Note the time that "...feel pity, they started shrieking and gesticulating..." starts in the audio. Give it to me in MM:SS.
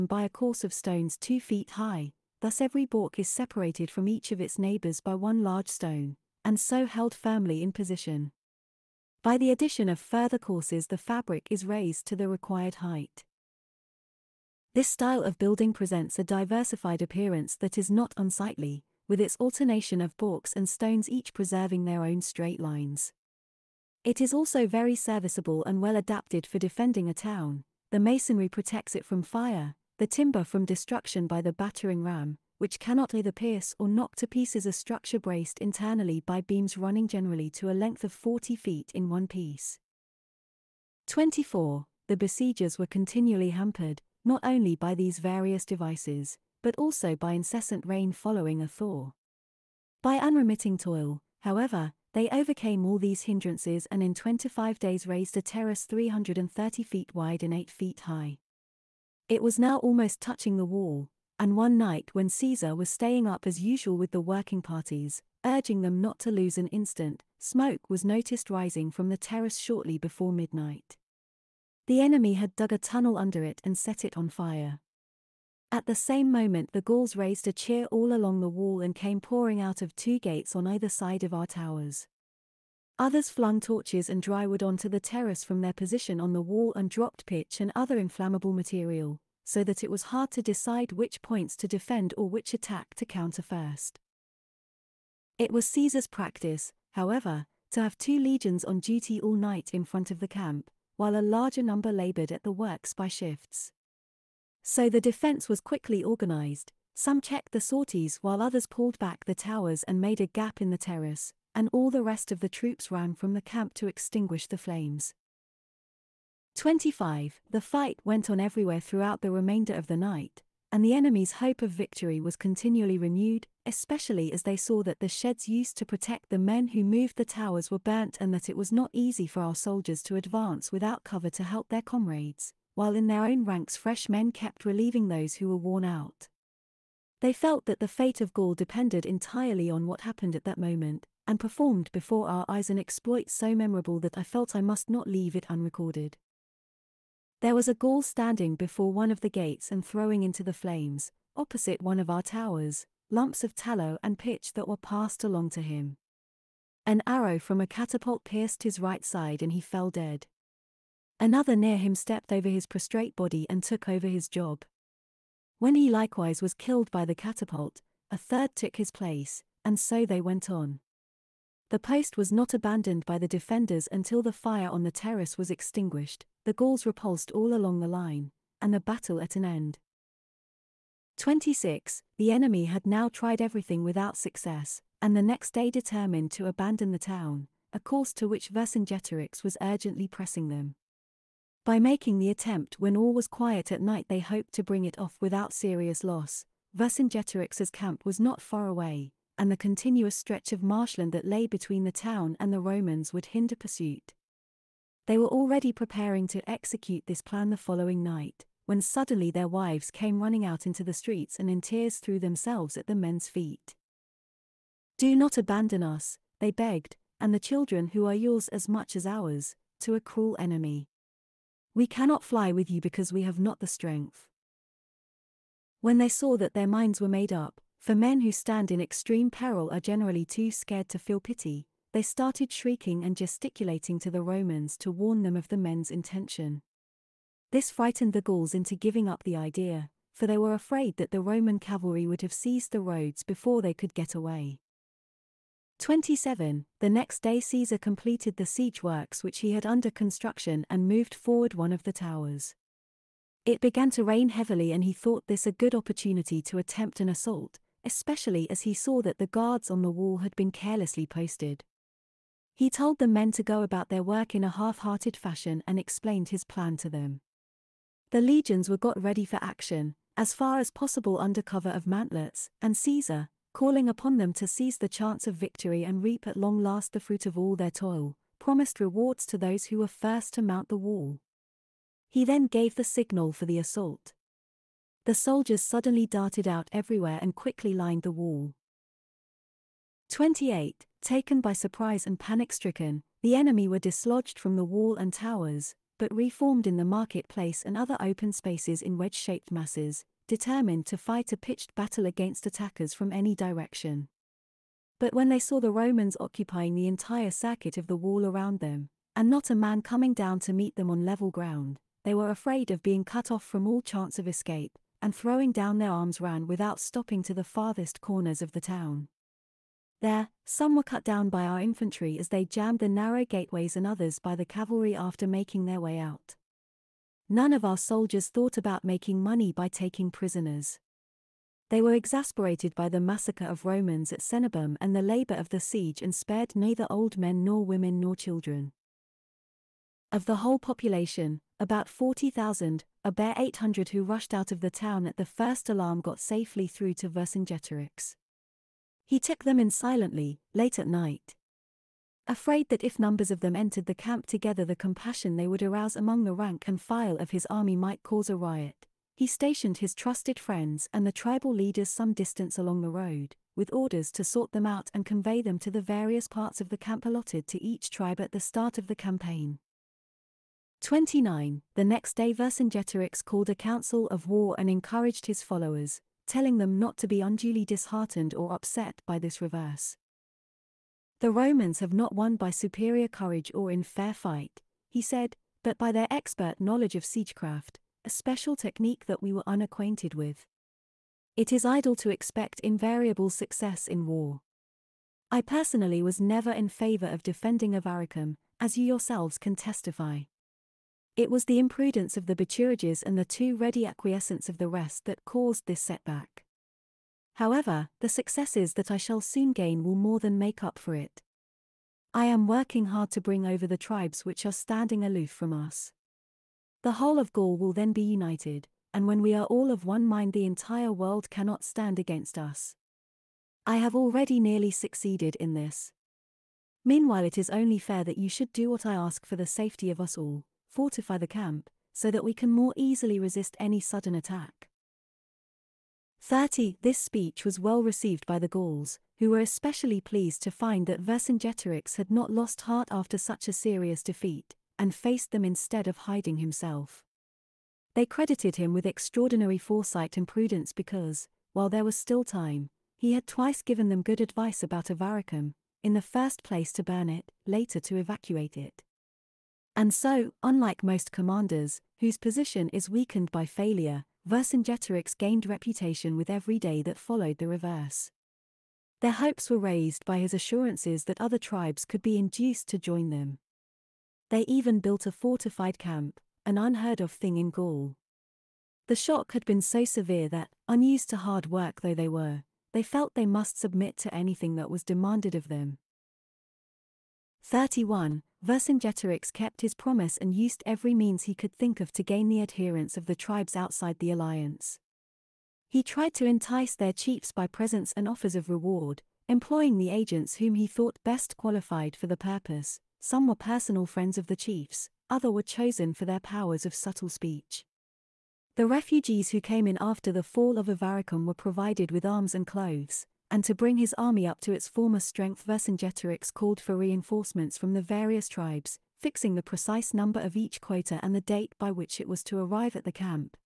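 03:50.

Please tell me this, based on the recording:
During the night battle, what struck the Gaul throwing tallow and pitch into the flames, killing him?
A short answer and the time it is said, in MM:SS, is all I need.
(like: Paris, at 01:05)
An arrow from a catapult, at 02:36.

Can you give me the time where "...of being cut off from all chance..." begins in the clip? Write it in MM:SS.
05:12.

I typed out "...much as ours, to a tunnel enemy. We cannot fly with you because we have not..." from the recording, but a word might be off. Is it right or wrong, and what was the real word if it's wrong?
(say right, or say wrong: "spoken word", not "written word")
wrong: "cruel", not "tunnel".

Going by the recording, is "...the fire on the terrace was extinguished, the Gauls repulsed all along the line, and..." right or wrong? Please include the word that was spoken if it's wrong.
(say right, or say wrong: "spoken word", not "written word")
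right.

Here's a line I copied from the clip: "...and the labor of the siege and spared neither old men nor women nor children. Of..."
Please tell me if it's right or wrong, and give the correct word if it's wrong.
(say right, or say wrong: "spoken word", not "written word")
right.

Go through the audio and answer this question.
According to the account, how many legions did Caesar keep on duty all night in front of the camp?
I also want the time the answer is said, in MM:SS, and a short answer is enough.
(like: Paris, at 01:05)
2, at 01:37.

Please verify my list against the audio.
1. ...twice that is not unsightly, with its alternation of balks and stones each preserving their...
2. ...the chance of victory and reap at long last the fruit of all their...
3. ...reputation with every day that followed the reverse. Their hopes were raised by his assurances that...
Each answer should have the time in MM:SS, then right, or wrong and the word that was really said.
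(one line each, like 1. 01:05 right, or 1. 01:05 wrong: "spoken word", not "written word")
1. 00:17 wrong: "appearance", not "twice"
2. 04:34 right
3. 07:45 right.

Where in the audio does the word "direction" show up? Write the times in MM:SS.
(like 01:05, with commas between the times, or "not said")
05:03.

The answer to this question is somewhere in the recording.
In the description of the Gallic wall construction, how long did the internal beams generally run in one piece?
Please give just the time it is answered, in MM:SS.
00:38.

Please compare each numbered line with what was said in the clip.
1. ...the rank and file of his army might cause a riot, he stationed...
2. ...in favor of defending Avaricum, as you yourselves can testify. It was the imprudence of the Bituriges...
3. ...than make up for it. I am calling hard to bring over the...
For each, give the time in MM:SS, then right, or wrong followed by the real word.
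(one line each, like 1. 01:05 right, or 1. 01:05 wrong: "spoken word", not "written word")
1. 05:56 right
2. 06:36 right
3. 06:50 wrong: "working", not "calling".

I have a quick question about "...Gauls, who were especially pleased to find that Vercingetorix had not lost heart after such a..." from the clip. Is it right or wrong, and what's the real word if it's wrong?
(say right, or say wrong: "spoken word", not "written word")
right.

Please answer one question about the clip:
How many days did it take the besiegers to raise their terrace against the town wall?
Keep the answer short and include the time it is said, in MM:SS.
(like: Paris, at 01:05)
25, at 00:54.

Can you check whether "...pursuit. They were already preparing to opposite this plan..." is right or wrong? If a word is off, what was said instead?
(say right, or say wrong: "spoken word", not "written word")
wrong: "execute", not "opposite".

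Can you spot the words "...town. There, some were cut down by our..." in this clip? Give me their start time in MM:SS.
05:18.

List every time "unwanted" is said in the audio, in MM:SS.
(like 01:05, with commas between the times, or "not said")
not said.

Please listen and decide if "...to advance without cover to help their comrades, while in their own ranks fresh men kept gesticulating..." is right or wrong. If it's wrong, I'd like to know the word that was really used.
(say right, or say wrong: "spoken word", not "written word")
wrong: "relieving", not "gesticulating".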